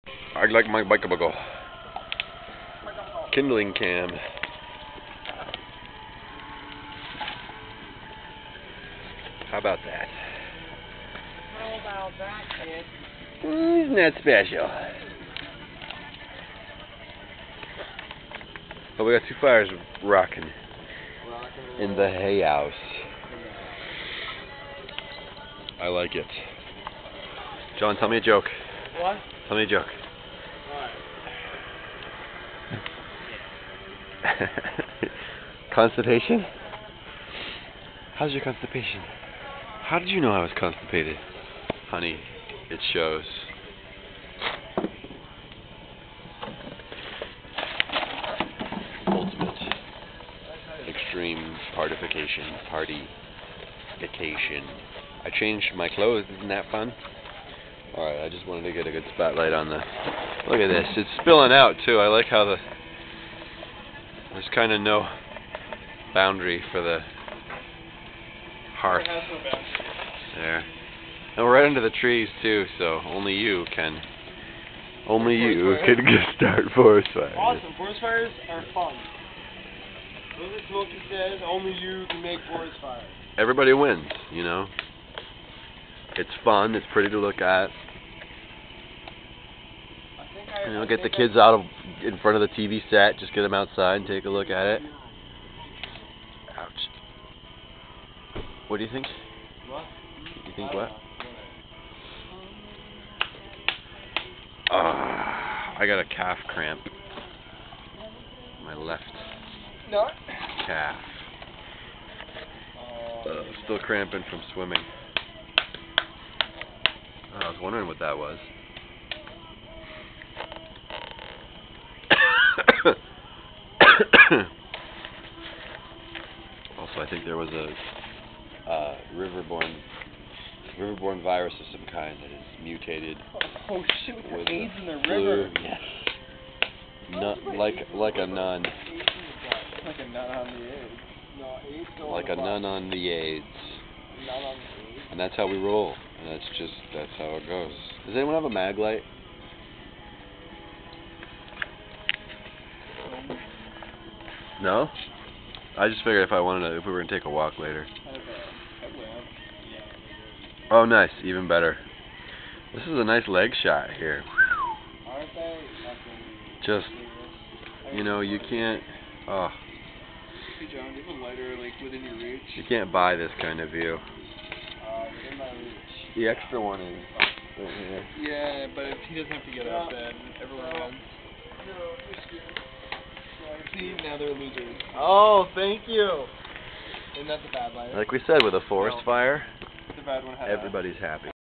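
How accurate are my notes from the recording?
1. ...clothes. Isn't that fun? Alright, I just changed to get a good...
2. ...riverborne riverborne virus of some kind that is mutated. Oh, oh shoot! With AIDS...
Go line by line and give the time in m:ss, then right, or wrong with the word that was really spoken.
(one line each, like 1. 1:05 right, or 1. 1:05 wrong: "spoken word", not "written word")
1. 0:55 wrong: "wanted", not "changed"
2. 2:09 right.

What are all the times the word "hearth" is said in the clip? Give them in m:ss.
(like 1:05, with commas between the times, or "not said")
1:08.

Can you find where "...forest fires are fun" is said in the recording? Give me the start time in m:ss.
1:17.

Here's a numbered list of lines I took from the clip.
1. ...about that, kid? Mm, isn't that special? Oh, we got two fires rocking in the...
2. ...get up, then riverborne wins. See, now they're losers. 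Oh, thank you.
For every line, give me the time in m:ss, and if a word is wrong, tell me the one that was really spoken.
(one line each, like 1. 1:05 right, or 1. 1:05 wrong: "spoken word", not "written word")
1. 0:11 right
2. 2:59 wrong: "everyone", not "riverborne".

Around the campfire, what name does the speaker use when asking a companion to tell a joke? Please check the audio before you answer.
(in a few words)
John.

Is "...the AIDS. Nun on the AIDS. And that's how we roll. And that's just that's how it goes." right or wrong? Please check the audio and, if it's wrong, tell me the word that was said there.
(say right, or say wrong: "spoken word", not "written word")
right.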